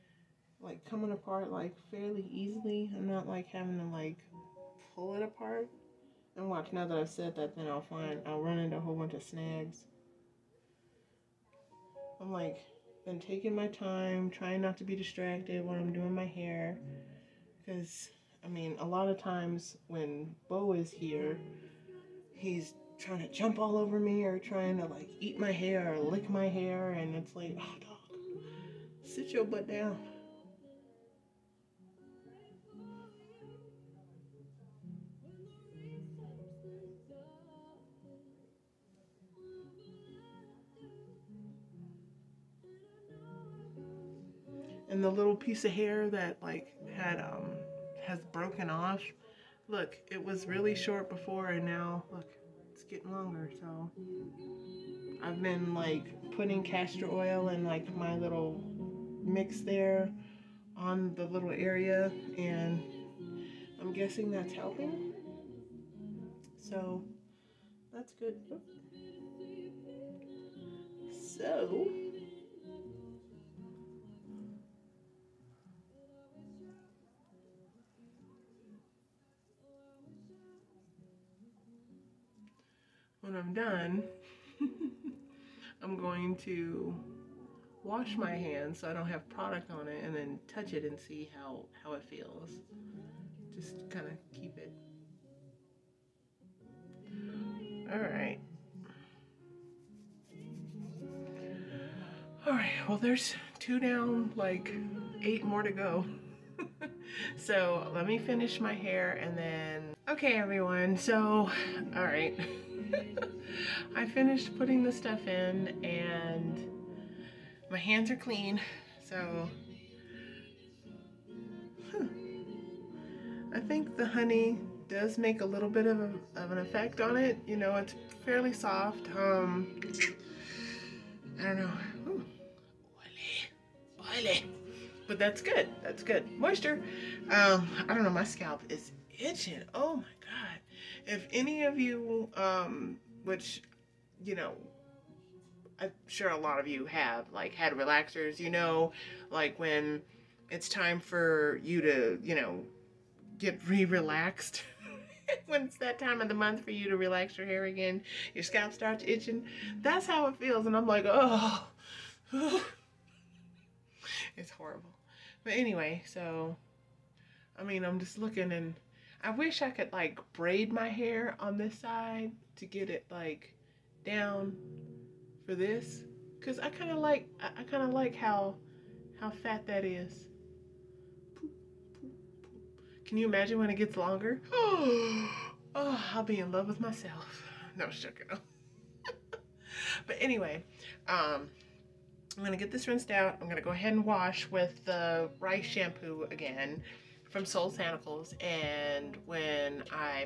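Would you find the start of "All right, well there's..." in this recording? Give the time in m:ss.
1:42.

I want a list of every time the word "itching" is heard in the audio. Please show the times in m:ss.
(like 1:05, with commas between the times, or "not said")
2:19, 2:39.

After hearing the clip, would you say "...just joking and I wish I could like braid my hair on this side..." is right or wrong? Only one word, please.
wrong.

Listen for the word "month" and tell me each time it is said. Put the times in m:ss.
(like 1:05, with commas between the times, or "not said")
2:36.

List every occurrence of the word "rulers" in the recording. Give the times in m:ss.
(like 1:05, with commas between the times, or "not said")
not said.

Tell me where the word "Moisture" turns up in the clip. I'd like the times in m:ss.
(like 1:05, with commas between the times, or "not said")
2:16.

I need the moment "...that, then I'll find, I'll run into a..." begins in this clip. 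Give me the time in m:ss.
0:07.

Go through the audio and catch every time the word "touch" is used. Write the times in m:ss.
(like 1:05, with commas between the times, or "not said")
1:30.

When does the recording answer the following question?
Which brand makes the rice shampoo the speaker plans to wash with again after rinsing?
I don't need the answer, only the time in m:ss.
3:17.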